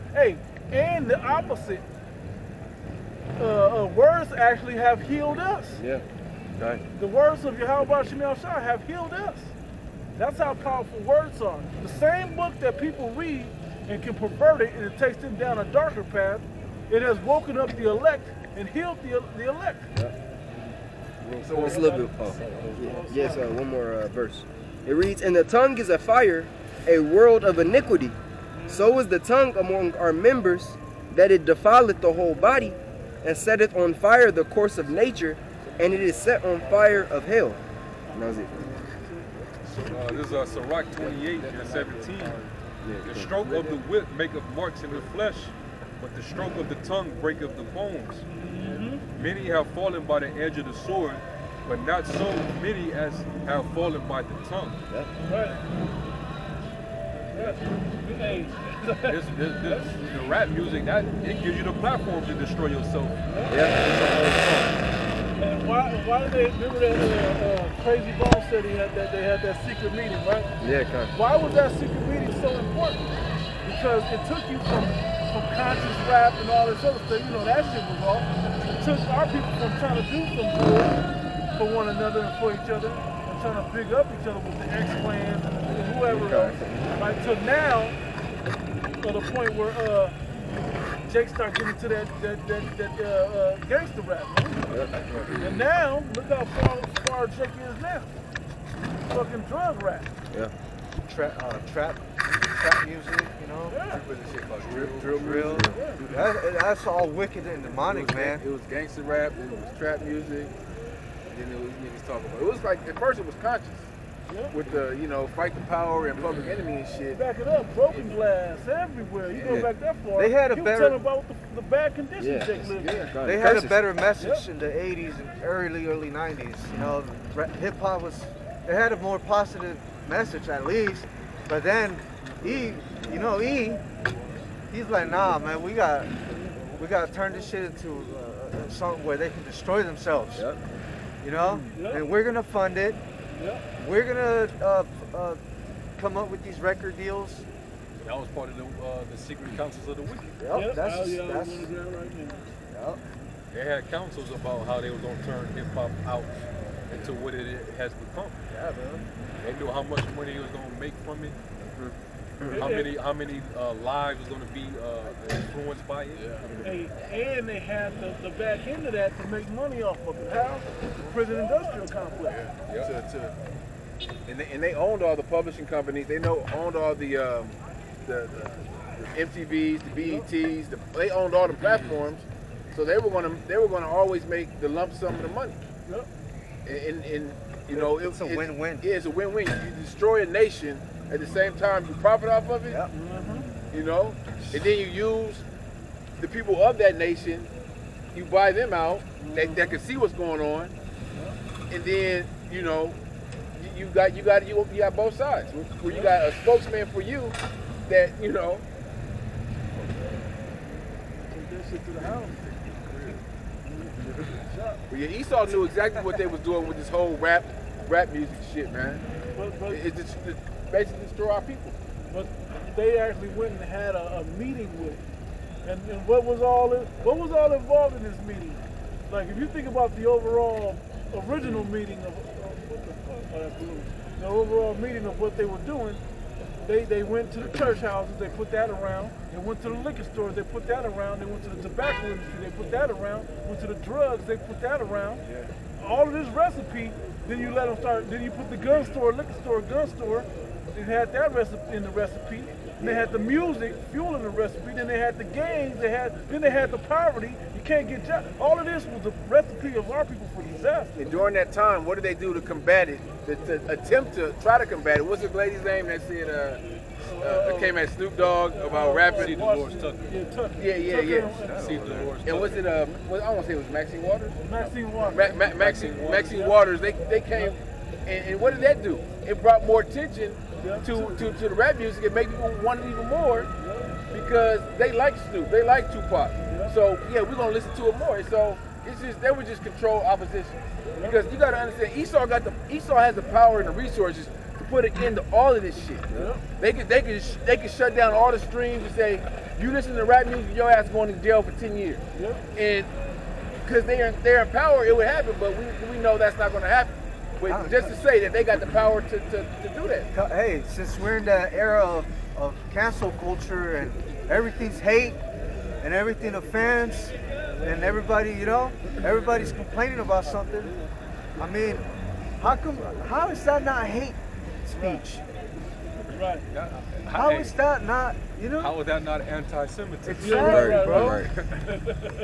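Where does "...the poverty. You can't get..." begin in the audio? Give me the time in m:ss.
4:16.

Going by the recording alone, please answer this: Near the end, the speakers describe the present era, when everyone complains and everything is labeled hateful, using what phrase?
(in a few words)
cancel culture.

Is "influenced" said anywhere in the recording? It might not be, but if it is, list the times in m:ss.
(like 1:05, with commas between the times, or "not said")
2:45.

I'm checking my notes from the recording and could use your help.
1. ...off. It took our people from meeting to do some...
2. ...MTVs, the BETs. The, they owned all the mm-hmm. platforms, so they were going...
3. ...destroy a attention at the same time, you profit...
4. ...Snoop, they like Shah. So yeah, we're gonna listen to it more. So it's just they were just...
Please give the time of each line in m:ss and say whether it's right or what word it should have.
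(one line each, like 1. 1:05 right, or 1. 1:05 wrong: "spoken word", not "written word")
1. 1:18 wrong: "trying", not "meeting"
2. 2:59 right
3. 3:09 wrong: "nation", not "attention"
4. 4:45 wrong: "Tupac", not "Shah".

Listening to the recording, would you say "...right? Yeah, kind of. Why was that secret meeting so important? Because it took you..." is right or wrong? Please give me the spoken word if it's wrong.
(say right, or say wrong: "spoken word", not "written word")
right.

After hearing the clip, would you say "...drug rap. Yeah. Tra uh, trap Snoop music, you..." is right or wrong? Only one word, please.
wrong.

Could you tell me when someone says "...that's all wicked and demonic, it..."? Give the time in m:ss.
1:46.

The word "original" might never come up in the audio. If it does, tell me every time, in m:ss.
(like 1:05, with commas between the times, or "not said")
3:51.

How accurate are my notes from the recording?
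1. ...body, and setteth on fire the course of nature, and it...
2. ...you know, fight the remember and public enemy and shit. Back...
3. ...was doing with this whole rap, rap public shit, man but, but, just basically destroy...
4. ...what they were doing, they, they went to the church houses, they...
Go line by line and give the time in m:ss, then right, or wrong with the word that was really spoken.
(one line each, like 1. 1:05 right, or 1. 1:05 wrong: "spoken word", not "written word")
1. 0:32 right
2. 1:54 wrong: "power", not "remember"
3. 3:36 wrong: "music", not "public"
4. 3:55 right.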